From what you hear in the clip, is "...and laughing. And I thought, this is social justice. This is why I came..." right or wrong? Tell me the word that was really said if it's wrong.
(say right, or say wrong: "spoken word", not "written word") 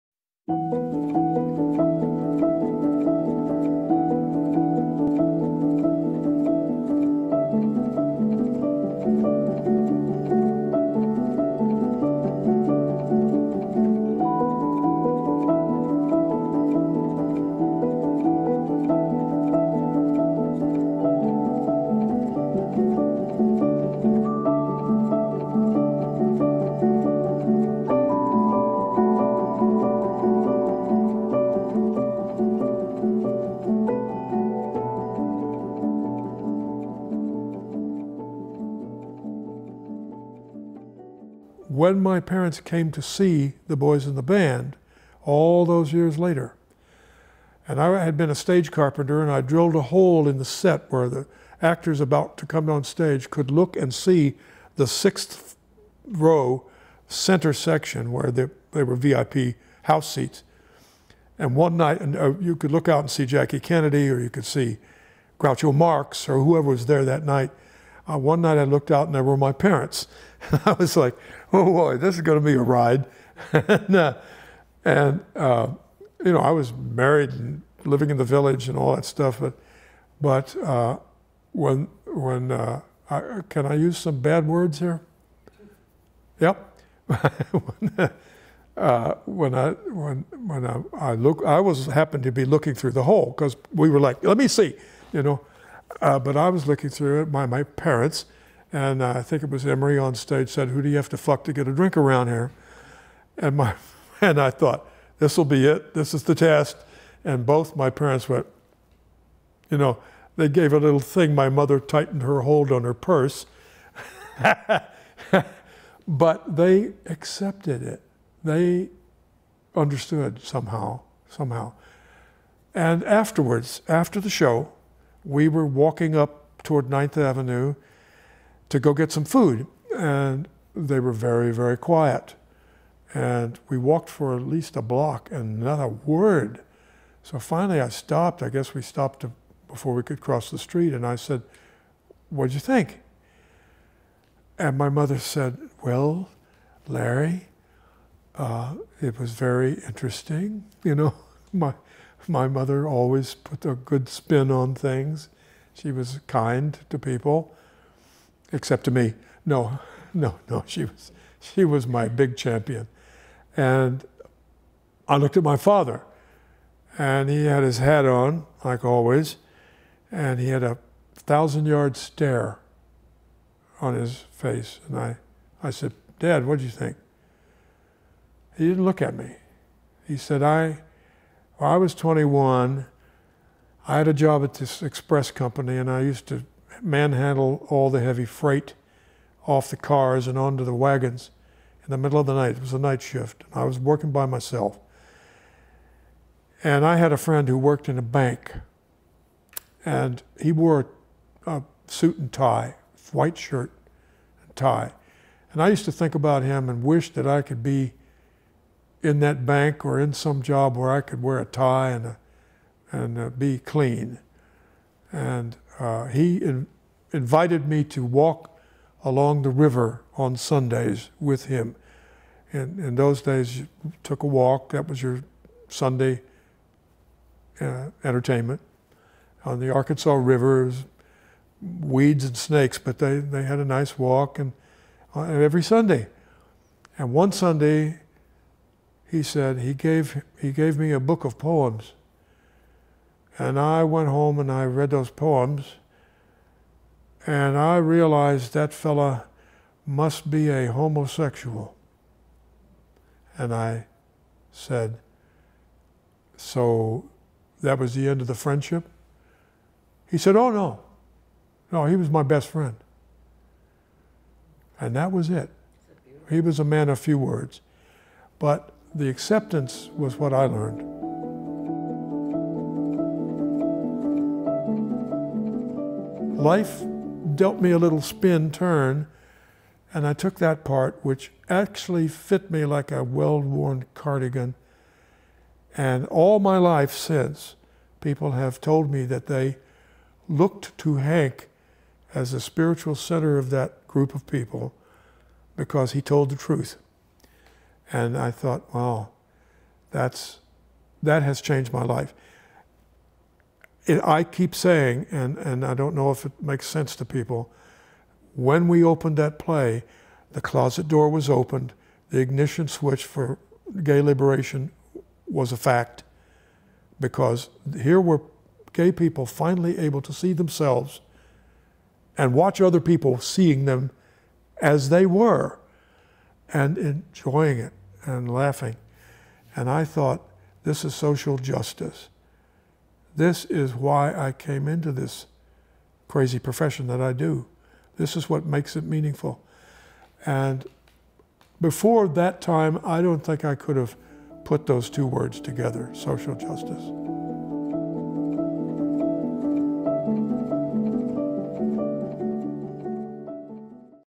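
right.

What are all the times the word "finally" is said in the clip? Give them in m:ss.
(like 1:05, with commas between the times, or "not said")
2:17, 5:19.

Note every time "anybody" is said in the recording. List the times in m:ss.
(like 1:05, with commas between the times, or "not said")
not said.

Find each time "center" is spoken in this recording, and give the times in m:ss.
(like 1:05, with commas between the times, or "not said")
0:57, 4:52.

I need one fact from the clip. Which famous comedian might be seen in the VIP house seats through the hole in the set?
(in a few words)
Groucho Marx.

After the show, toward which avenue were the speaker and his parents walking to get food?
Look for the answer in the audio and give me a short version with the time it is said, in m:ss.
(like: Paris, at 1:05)
Ninth Avenue, at 2:06.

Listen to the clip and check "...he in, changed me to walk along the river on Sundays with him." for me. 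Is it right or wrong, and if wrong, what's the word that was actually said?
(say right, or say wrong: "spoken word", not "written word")
wrong: "invited", not "changed".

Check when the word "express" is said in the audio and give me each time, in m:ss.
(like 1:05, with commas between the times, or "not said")
3:04.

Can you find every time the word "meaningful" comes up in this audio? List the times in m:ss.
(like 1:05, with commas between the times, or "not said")
5:38.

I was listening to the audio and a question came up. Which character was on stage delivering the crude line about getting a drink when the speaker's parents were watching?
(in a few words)
Emery.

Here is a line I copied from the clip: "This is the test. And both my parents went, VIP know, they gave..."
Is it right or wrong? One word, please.
wrong.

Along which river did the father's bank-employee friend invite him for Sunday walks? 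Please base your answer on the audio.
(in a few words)
Arkansas River.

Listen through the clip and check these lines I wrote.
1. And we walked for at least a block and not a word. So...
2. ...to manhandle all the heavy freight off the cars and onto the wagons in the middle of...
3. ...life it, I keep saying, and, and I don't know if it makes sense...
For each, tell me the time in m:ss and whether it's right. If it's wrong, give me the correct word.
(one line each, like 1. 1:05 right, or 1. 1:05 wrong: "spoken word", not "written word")
1. 2:13 right
2. 3:06 right
3. 5:01 right.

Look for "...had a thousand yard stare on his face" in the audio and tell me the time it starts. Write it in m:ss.
2:50.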